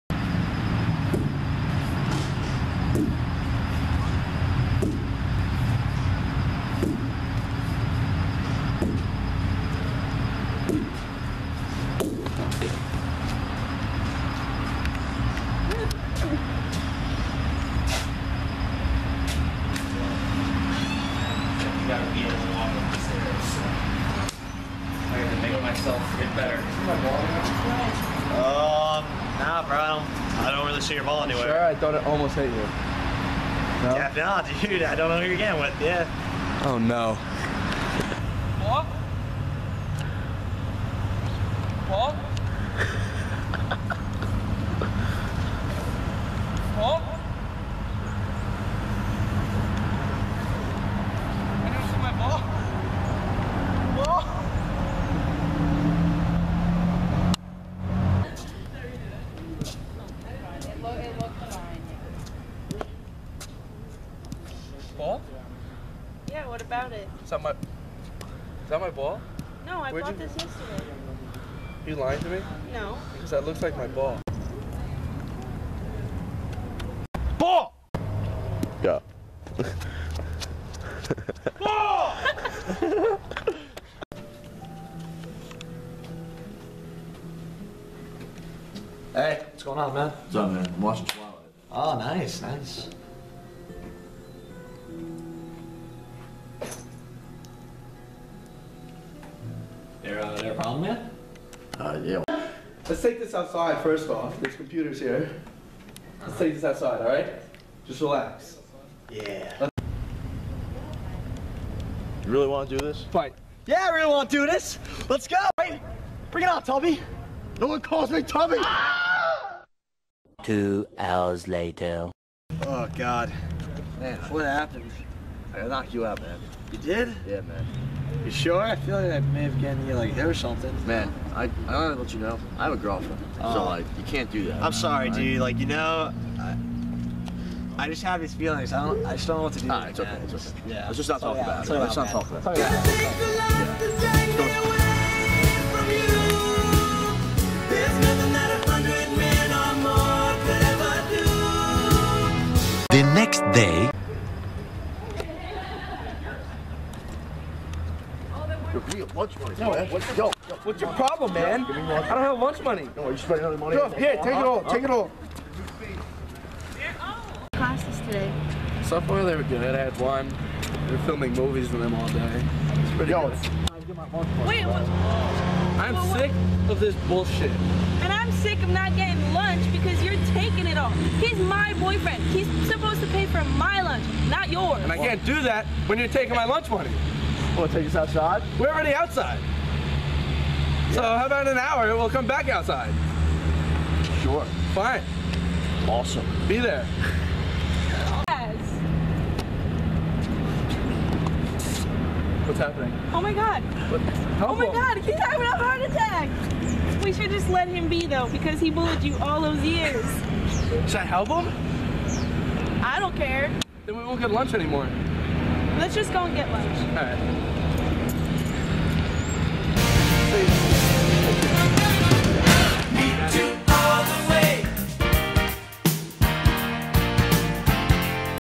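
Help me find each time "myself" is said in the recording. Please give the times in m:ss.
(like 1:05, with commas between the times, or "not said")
0:25.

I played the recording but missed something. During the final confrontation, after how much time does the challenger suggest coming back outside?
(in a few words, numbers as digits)
An hour.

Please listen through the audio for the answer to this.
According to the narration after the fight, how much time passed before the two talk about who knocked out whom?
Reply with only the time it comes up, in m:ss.
2:00.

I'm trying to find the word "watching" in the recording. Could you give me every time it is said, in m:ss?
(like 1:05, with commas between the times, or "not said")
1:30.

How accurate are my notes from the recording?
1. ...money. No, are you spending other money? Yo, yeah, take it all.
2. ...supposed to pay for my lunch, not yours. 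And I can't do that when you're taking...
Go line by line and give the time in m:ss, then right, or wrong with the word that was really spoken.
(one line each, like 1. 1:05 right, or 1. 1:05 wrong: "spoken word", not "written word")
1. 2:42 right
2. 3:02 right.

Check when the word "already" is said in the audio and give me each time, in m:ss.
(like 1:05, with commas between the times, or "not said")
3:08.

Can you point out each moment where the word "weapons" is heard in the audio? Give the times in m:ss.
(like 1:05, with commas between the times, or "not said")
not said.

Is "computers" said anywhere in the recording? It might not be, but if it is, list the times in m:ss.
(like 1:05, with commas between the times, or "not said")
1:44.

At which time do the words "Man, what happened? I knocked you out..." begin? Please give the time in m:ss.
2:03.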